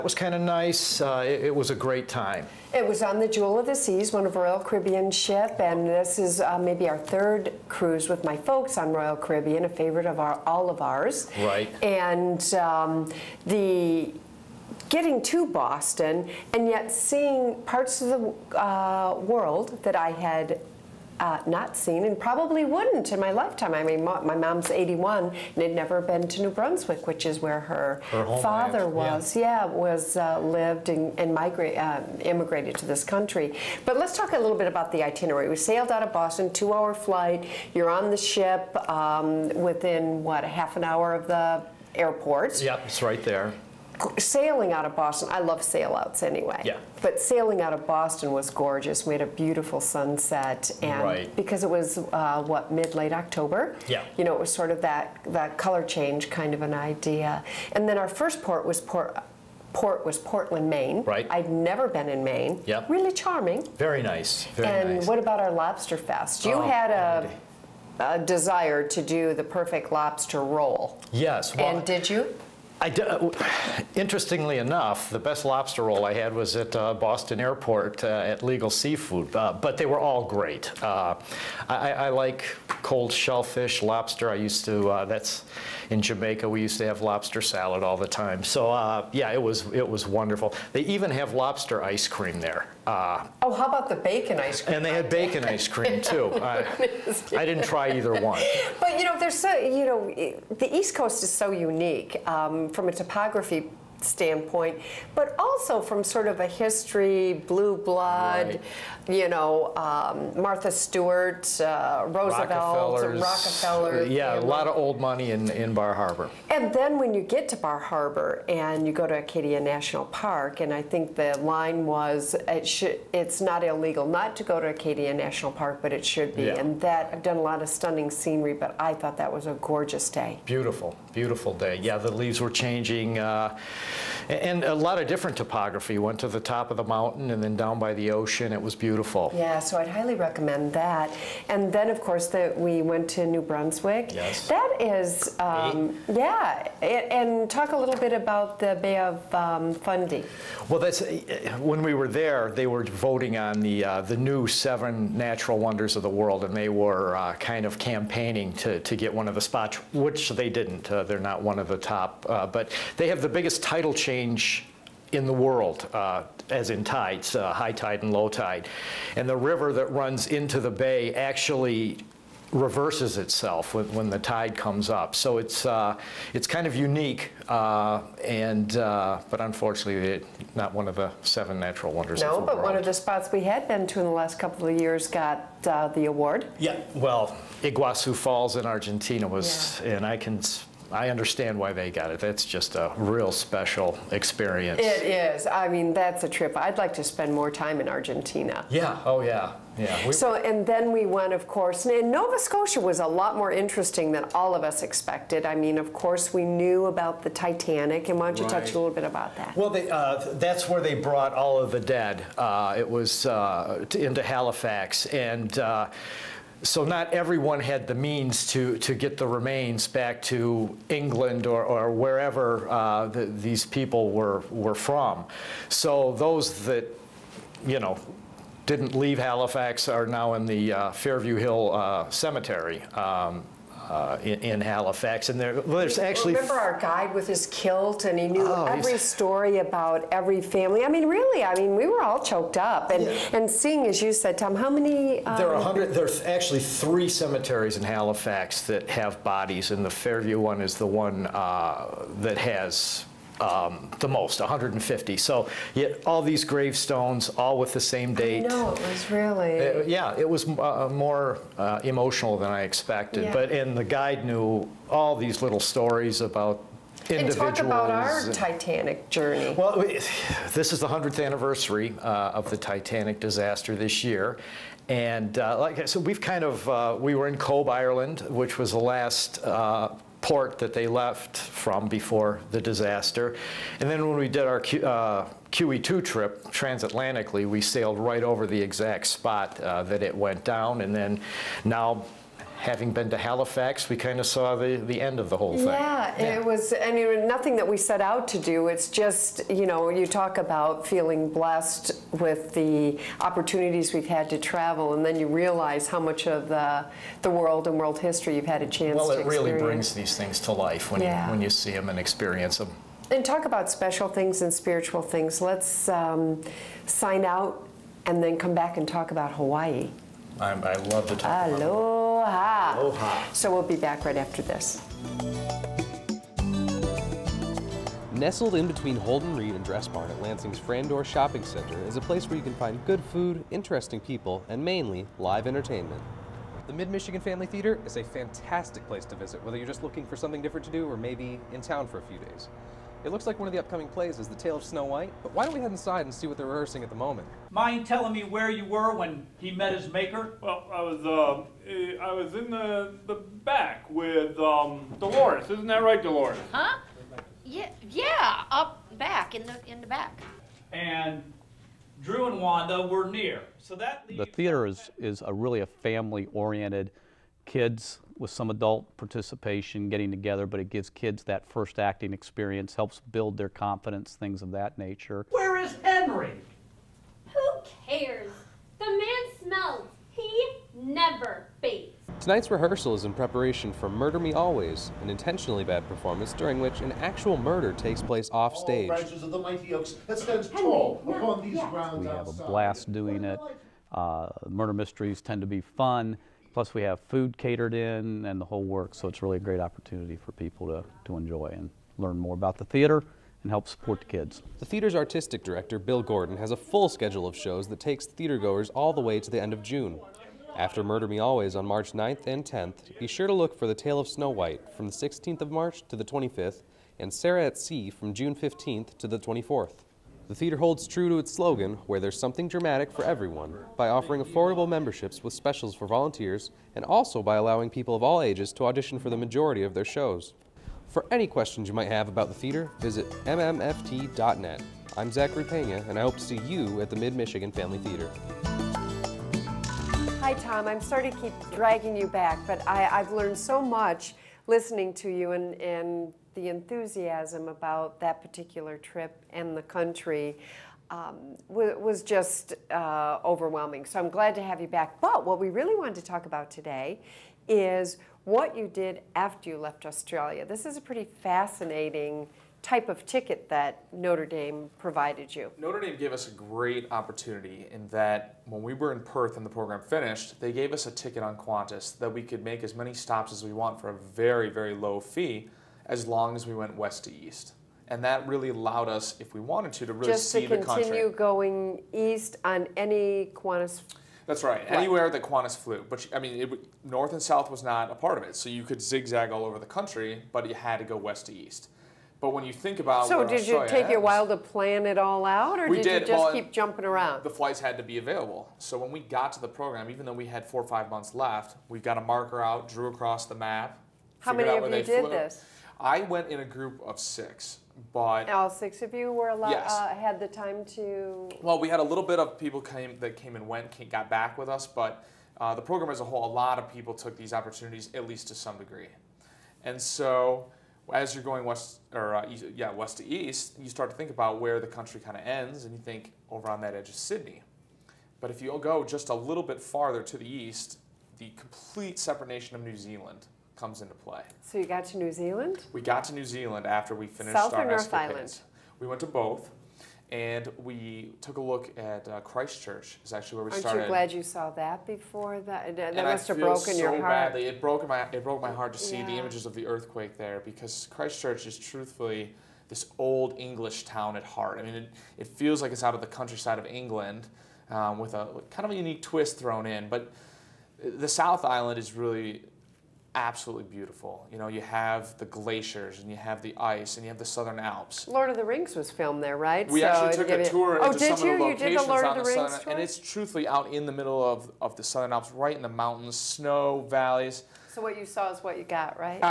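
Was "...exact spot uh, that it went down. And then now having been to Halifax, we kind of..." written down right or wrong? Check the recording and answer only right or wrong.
right.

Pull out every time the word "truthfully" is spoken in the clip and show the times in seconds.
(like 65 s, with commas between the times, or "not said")
551 s, 572 s.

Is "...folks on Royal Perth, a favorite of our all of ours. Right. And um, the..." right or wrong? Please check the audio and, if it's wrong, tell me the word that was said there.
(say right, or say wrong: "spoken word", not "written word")
wrong: "Caribbean", not "Perth".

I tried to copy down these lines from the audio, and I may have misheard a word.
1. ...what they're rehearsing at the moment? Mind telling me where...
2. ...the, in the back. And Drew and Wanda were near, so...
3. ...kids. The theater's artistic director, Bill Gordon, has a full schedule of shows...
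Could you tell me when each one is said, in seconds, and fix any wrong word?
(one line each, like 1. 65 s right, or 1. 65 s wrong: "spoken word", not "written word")
1. 346 s right
2. 359 s right
3. 404 s right.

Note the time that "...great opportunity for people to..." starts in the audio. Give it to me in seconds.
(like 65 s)
399 s.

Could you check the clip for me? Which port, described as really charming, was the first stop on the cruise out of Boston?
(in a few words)
Portland, Maine.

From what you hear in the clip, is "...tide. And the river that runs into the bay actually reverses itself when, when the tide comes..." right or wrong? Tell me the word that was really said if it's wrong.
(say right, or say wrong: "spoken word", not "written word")
right.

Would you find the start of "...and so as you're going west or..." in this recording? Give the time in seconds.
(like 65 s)
519 s.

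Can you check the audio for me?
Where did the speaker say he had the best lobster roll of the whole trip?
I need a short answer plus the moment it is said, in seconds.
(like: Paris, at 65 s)
Legal Seafood, at 78 s.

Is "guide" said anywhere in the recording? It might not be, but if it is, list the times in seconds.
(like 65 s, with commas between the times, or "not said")
236 s, 263 s.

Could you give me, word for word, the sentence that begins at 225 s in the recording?
So those that, you know, didn't leave Halifax are now in the uh, Fairview Hill uh, Cemetery.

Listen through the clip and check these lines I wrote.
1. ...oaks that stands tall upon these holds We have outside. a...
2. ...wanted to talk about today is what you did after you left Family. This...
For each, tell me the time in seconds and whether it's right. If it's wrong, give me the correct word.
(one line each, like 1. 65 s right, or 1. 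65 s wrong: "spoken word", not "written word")
1. 389 s wrong: "grounds", not "holds"
2. 455 s wrong: "Australia", not "Family".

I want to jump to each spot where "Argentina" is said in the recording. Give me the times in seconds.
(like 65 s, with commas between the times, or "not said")
188 s, 197 s.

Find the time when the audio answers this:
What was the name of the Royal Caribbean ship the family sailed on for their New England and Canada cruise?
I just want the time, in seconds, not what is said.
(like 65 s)
3 s.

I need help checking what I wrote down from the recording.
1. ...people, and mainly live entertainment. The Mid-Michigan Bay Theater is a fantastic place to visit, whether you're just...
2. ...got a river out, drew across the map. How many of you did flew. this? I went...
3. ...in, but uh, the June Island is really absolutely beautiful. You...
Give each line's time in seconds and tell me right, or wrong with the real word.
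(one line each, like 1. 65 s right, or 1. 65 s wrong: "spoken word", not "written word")
1. 333 s wrong: "Family", not "Bay"
2. 501 s wrong: "marker", not "river"
3. 559 s wrong: "South", not "June".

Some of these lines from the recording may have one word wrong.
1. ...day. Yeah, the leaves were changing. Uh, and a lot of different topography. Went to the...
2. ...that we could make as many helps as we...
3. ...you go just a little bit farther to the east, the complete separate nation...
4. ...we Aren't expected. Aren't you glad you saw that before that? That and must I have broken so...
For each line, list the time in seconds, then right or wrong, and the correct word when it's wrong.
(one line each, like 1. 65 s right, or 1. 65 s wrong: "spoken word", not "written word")
1. 131 s right
2. 471 s wrong: "stops", not "helps"
3. 528 s right
4. 543 s wrong: "started", not "expected".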